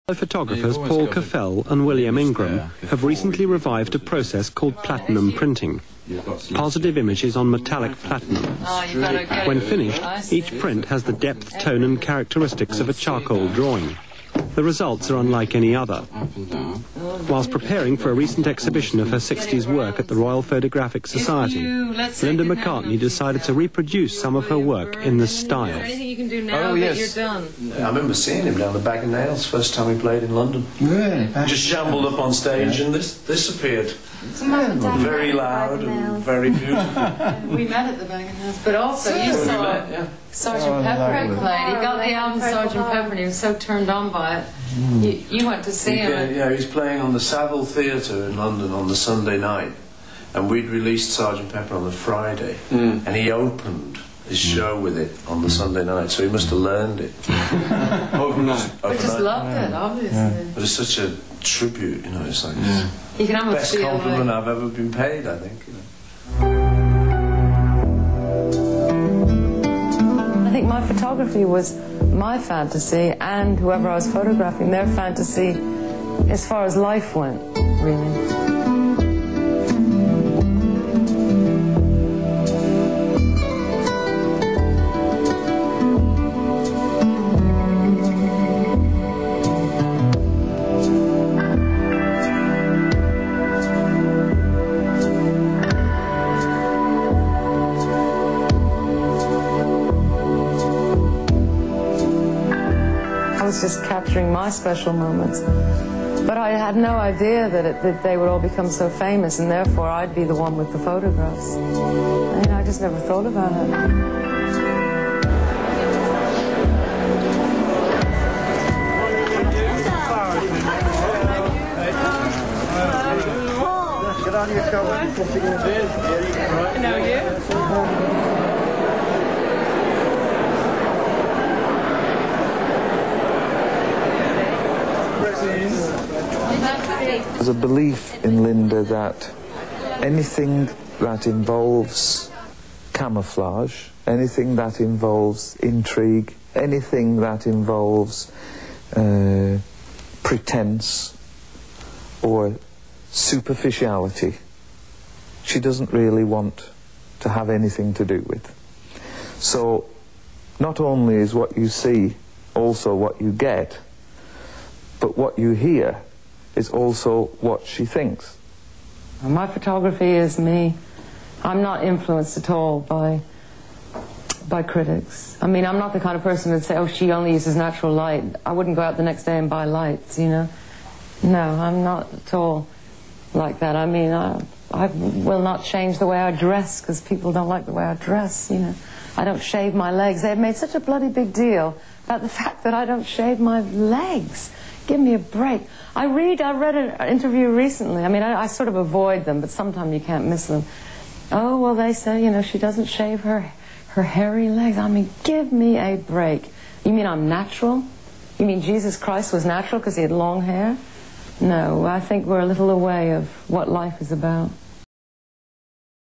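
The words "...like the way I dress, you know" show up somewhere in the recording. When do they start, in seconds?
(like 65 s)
187 s.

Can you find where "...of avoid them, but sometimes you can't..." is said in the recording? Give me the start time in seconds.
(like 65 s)
198 s.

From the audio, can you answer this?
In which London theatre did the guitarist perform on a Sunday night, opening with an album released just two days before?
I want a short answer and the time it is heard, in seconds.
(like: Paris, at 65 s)
Saville Theatre, at 47 s.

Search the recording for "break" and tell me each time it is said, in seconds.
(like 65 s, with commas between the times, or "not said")
195 s, 205 s.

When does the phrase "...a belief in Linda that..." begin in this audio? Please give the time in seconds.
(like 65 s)
137 s.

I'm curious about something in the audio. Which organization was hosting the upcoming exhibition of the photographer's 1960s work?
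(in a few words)
Royal Photographic Society.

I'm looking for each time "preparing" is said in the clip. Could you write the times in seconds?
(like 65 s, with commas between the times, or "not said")
17 s.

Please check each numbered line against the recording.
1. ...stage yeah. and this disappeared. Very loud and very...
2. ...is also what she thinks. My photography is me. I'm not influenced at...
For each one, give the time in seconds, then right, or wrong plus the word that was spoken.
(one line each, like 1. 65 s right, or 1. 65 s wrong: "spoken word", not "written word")
1. 32 s right
2. 166 s right.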